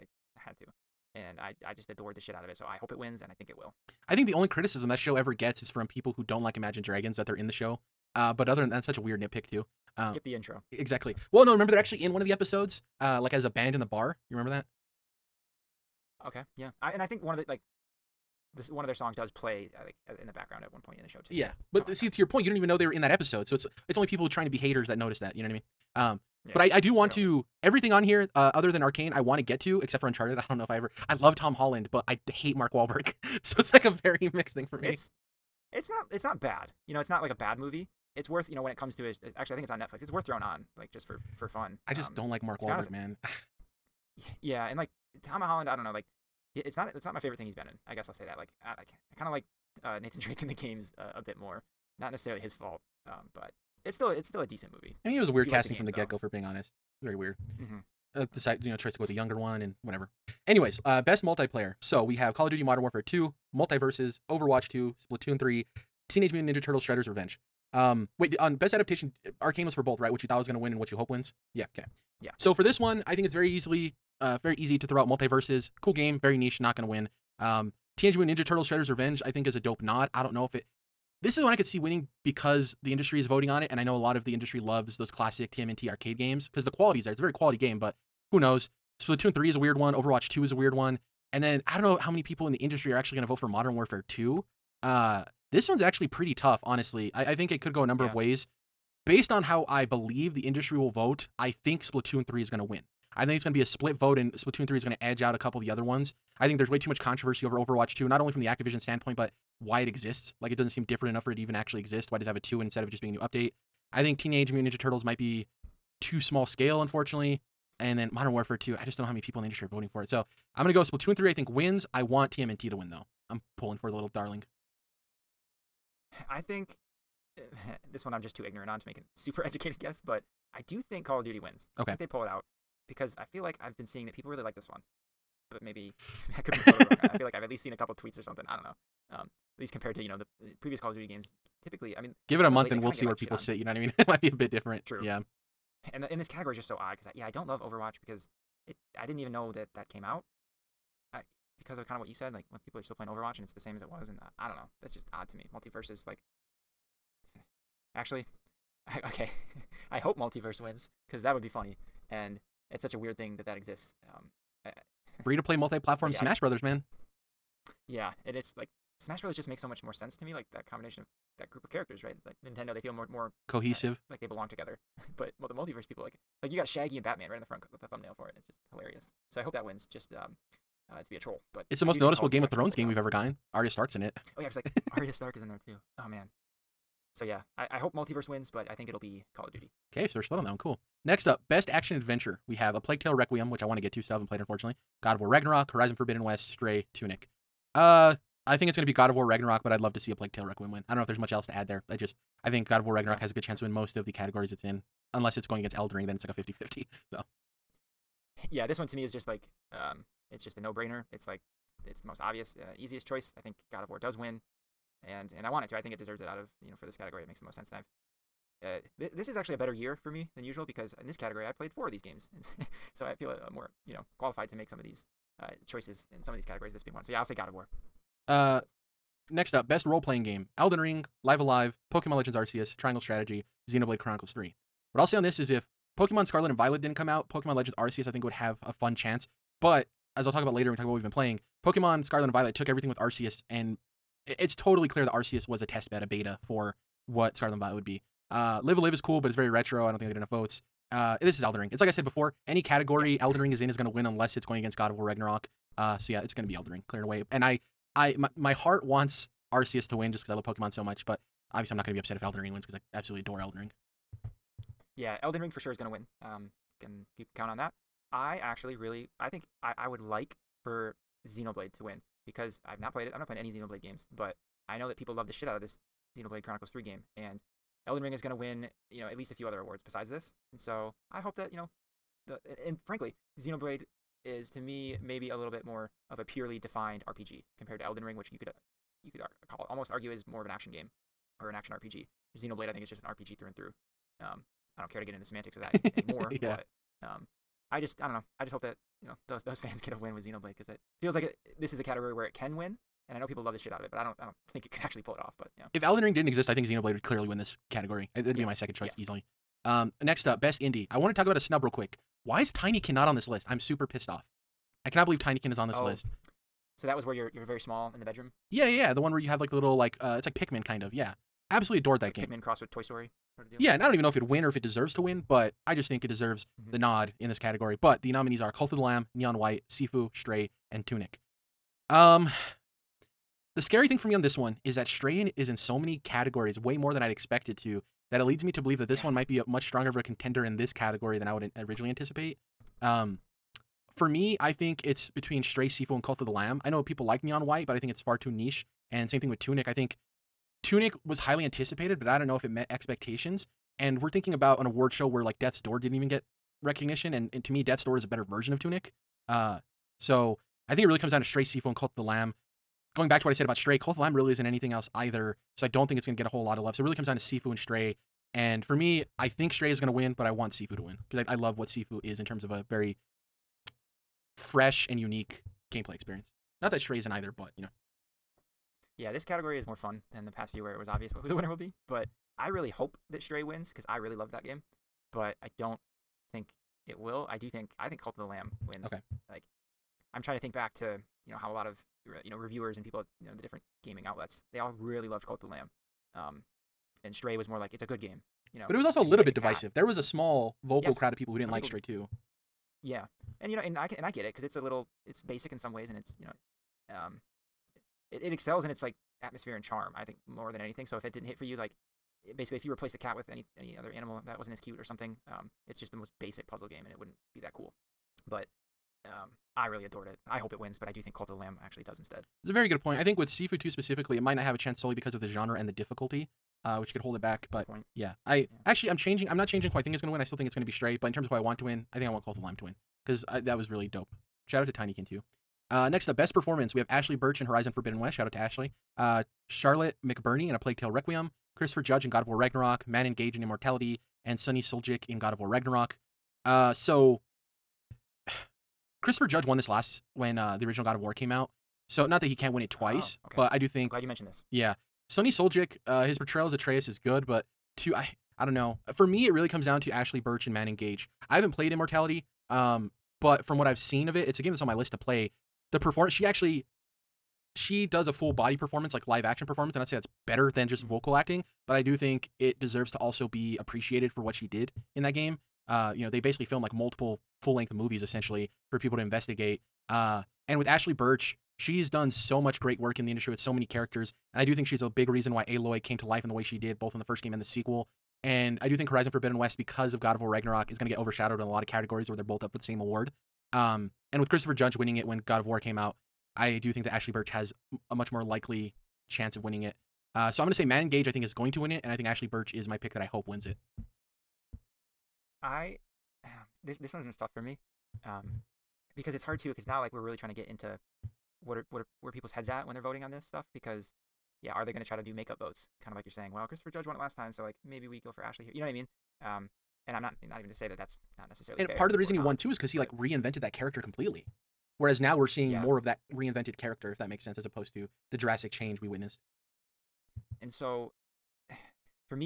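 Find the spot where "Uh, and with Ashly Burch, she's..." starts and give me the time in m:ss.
7:59.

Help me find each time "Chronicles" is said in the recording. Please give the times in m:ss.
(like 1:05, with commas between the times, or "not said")
3:53, 4:36.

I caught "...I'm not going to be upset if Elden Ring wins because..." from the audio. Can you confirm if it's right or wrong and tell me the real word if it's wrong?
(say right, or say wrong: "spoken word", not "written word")
right.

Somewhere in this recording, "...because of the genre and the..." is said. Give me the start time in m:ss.
7:04.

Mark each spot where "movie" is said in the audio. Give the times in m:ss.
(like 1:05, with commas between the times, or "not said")
0:37, 0:54, 7:57.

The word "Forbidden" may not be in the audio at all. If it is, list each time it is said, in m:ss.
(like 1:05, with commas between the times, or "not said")
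3:15, 7:17, 8:09.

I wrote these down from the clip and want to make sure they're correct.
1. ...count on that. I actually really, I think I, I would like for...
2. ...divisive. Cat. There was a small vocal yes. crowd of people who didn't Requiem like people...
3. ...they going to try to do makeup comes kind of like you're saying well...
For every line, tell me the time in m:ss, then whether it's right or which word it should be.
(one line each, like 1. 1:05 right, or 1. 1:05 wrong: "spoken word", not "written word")
1. 4:27 right
2. 6:39 wrong: "Some", not "Requiem"
3. 8:34 wrong: "votes", not "comes".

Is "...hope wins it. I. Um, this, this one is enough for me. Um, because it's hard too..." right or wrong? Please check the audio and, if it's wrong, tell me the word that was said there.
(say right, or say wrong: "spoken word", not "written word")
wrong: "tough", not "enough".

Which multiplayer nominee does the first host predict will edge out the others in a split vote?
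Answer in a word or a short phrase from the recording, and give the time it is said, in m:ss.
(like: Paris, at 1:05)
Splatoon 3, at 1:41.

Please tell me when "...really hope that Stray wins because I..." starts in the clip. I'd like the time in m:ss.
6:22.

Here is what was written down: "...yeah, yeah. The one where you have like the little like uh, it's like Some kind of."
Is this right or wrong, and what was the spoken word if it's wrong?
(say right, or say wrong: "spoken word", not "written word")
wrong: "Pikmin", not "Some".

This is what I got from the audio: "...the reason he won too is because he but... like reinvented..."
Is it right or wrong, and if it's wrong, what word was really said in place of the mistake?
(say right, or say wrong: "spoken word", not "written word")
right.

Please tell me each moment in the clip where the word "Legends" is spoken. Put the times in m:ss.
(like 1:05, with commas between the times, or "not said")
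3:52, 3:57.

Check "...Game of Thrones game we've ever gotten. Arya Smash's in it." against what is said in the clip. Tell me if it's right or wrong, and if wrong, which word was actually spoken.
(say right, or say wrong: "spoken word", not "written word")
wrong: "Stark", not "Smash".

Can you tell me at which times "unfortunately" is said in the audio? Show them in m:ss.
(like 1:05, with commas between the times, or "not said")
1:56, 3:14.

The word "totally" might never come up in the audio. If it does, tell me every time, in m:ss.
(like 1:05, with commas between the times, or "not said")
2:16, 4:04.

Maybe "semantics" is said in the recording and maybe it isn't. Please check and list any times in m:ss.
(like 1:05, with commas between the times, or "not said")
4:55.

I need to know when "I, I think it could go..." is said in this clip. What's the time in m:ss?
1:37.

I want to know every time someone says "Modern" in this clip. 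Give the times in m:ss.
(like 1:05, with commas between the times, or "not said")
1:02, 1:33, 1:58.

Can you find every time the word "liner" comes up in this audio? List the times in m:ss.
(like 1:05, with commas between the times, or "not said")
not said.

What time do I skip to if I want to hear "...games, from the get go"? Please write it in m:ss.
0:55.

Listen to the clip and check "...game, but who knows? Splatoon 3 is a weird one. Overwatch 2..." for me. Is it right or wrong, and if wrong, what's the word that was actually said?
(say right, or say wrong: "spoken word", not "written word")
right.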